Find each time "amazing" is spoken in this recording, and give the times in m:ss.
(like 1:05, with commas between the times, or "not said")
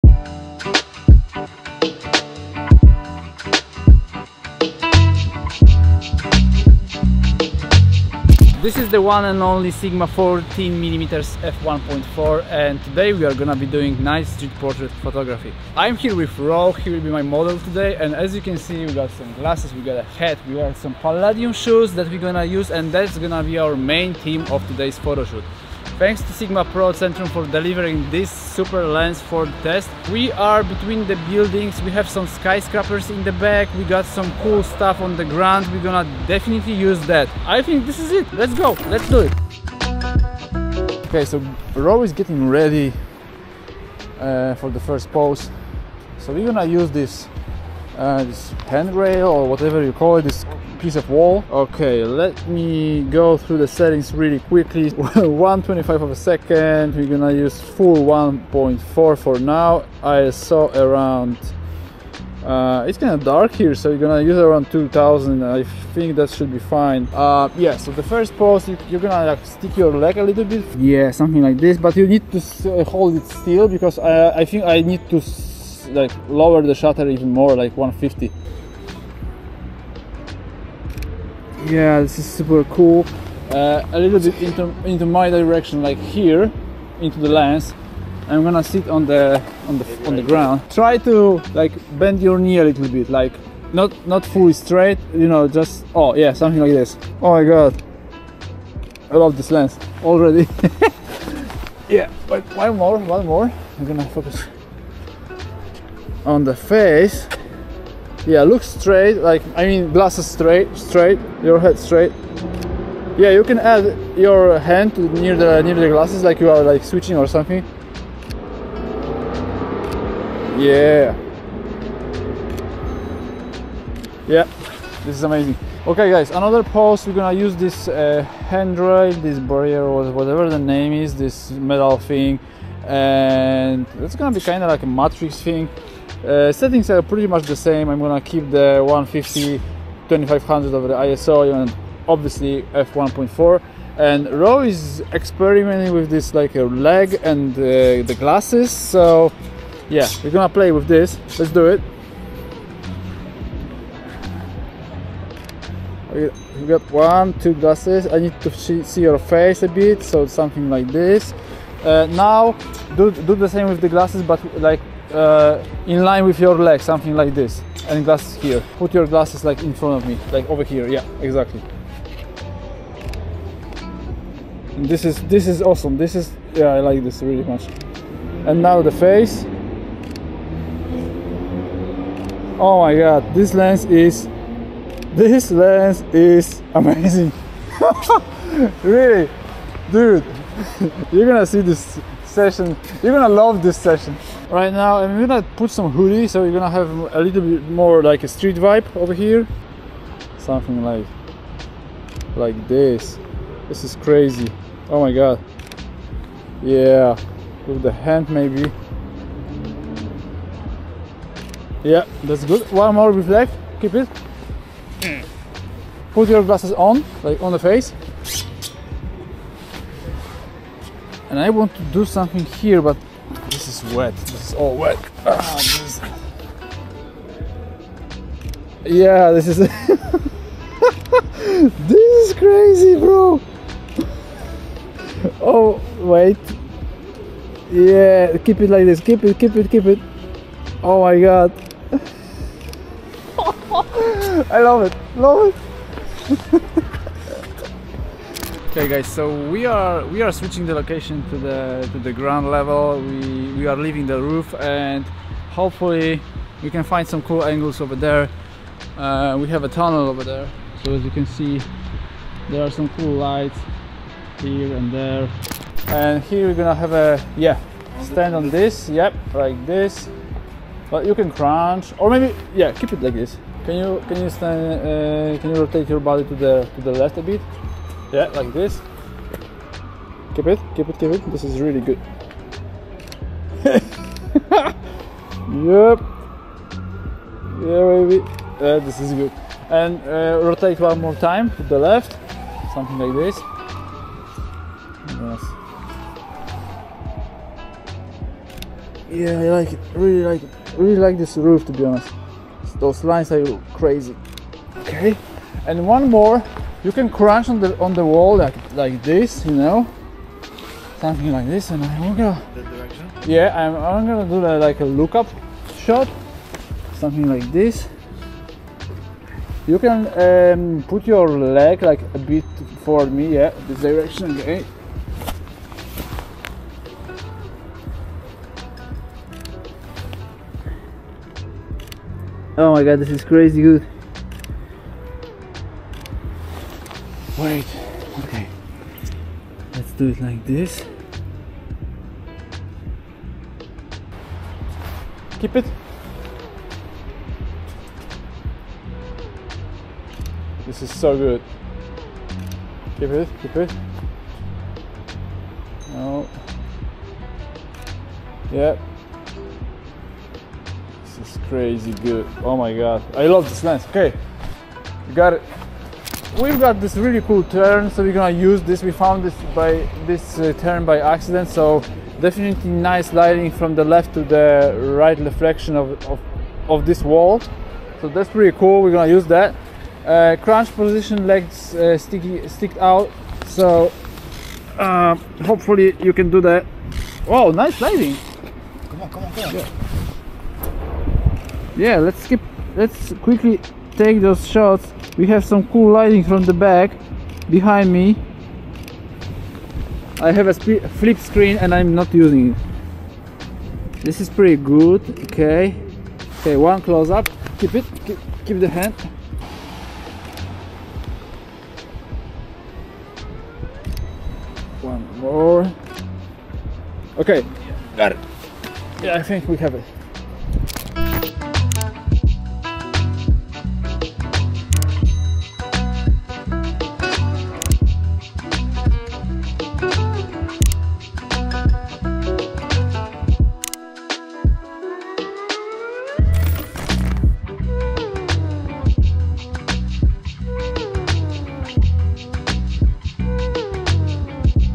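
2:05, 3:06.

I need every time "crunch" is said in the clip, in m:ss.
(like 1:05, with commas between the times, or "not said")
4:31, 5:07, 6:20.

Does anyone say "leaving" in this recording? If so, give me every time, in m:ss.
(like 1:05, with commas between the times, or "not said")
4:13.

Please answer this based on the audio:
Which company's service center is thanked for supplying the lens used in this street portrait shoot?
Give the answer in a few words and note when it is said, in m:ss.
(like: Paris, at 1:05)
Sigma Pro Centrum, at 0:26.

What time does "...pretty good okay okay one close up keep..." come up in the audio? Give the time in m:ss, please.
6:44.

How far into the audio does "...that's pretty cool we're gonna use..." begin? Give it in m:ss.
6:18.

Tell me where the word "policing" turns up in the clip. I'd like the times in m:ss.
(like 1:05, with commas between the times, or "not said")
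not said.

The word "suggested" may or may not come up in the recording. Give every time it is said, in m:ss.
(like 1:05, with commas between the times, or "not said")
not said.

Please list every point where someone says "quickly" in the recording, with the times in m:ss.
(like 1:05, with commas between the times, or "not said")
0:54, 6:33.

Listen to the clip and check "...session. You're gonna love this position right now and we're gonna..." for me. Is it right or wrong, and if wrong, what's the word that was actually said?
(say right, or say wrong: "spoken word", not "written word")
wrong: "session", not "position".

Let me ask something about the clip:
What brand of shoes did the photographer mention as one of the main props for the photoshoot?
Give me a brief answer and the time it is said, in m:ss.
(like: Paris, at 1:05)
Palladium, at 0:20.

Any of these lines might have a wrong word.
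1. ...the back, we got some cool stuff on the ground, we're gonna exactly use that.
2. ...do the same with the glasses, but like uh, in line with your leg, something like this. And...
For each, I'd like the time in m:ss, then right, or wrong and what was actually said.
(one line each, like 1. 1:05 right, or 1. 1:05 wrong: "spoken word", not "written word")
1. 0:33 wrong: "definitely", not "exactly"
2. 2:43 right.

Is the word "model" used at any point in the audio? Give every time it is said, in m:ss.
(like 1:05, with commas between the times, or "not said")
0:17.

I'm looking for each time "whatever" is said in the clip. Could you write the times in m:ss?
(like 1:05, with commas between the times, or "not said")
0:49, 2:10.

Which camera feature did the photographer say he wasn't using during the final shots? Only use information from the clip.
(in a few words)
Flip screen.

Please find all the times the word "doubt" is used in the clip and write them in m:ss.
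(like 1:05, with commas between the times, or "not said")
not said.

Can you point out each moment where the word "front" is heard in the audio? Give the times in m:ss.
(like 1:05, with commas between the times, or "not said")
2:49.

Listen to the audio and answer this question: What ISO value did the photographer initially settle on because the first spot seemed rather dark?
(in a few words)
2000.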